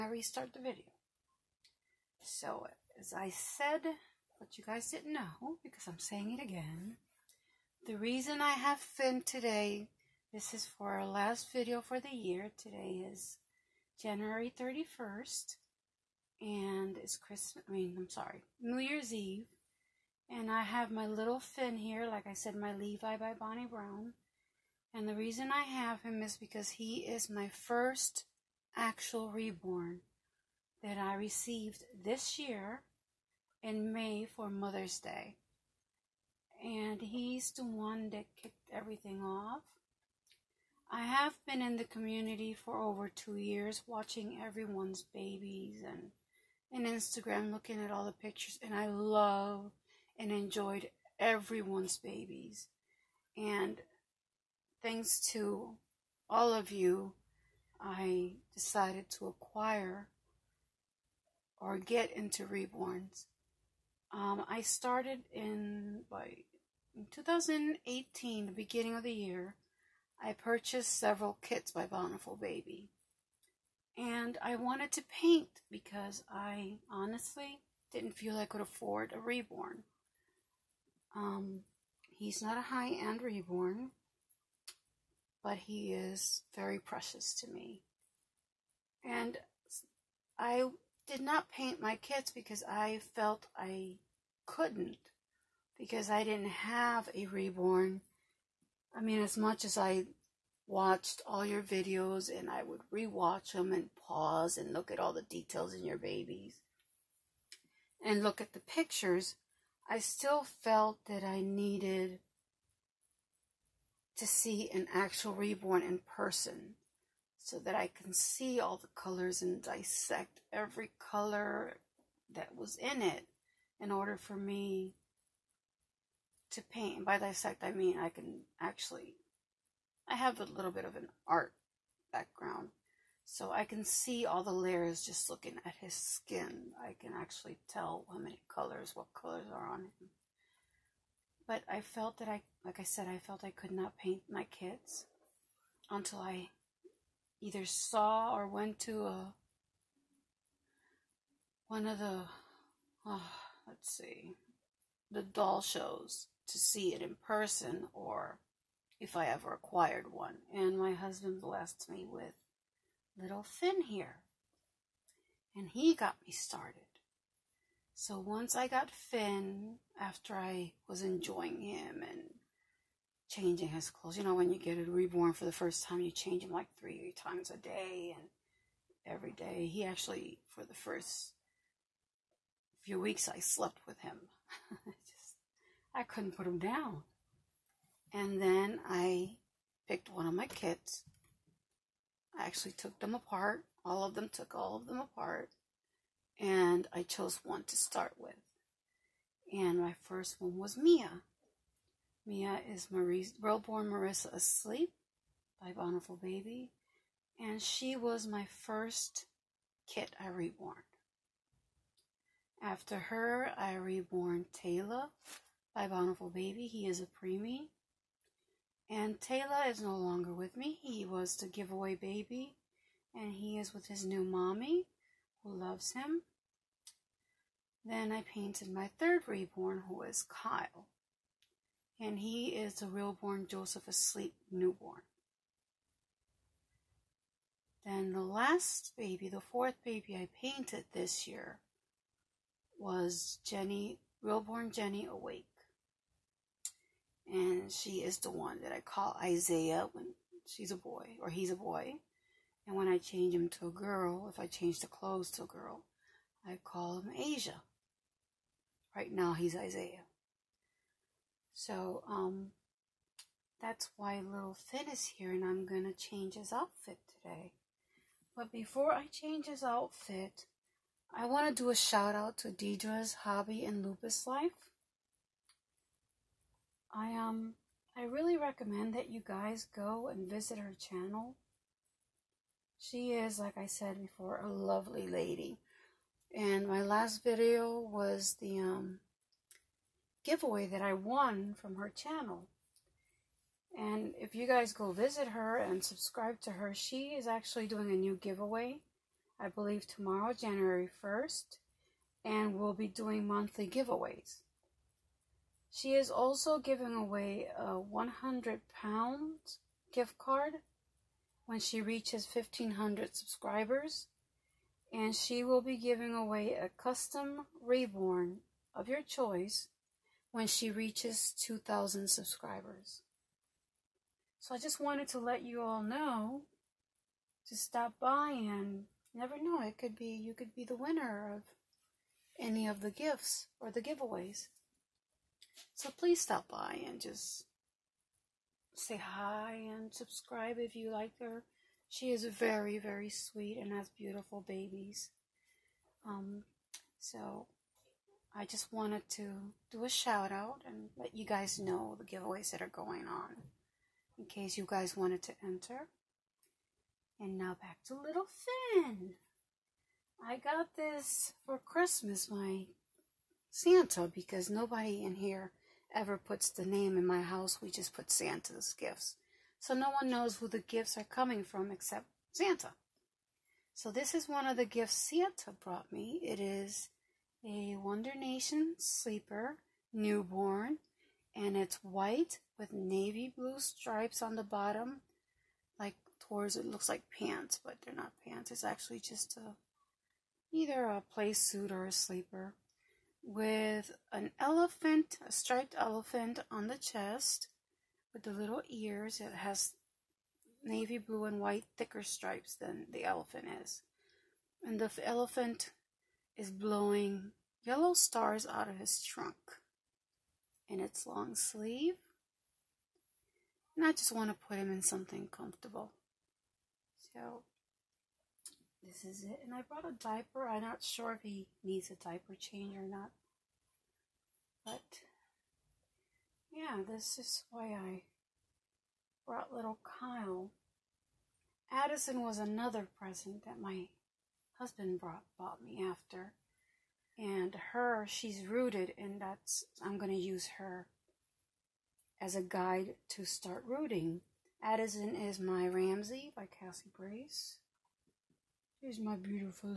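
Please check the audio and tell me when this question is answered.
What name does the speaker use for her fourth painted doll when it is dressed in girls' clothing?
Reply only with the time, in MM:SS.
04:17.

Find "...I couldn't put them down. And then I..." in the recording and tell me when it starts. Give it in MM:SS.
03:05.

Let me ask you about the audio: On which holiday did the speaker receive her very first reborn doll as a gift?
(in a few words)
Mother's Day.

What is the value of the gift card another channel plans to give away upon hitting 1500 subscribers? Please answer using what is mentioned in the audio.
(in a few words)
100 pounds.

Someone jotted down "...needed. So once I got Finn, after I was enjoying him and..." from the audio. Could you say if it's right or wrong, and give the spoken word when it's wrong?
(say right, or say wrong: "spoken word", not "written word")
wrong: "started", not "needed".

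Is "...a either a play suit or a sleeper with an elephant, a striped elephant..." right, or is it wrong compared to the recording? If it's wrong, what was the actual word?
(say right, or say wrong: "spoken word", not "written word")
right.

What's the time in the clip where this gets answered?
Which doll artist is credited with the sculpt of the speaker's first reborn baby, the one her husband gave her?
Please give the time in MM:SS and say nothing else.
00:23.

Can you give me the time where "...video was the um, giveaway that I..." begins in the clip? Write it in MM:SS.
04:47.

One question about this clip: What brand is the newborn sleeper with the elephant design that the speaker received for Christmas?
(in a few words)
Wonder Nation.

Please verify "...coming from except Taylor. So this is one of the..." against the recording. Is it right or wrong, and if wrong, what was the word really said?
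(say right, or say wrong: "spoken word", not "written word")
wrong: "Santa", not "Taylor".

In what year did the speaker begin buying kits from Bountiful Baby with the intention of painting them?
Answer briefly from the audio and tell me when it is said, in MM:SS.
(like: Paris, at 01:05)
2018, at 01:07.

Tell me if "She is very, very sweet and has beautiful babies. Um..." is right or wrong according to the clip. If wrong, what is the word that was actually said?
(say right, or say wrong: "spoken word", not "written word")
right.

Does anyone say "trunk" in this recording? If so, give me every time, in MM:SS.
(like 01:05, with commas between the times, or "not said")
06:49.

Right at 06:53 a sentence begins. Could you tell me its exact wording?
And I just want to put him in something comfortable.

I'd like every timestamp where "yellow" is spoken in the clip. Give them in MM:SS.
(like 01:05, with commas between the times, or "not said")
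06:47.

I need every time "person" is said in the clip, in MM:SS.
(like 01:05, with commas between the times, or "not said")
01:56, 02:37.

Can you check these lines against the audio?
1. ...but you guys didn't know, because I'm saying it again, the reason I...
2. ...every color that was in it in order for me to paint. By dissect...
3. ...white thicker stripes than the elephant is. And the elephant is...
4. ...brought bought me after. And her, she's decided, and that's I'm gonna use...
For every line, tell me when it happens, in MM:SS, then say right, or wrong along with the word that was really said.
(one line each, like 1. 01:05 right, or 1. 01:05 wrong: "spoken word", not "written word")
1. 00:04 right
2. 02:00 right
3. 06:41 right
4. 07:14 wrong: "rooted", not "decided".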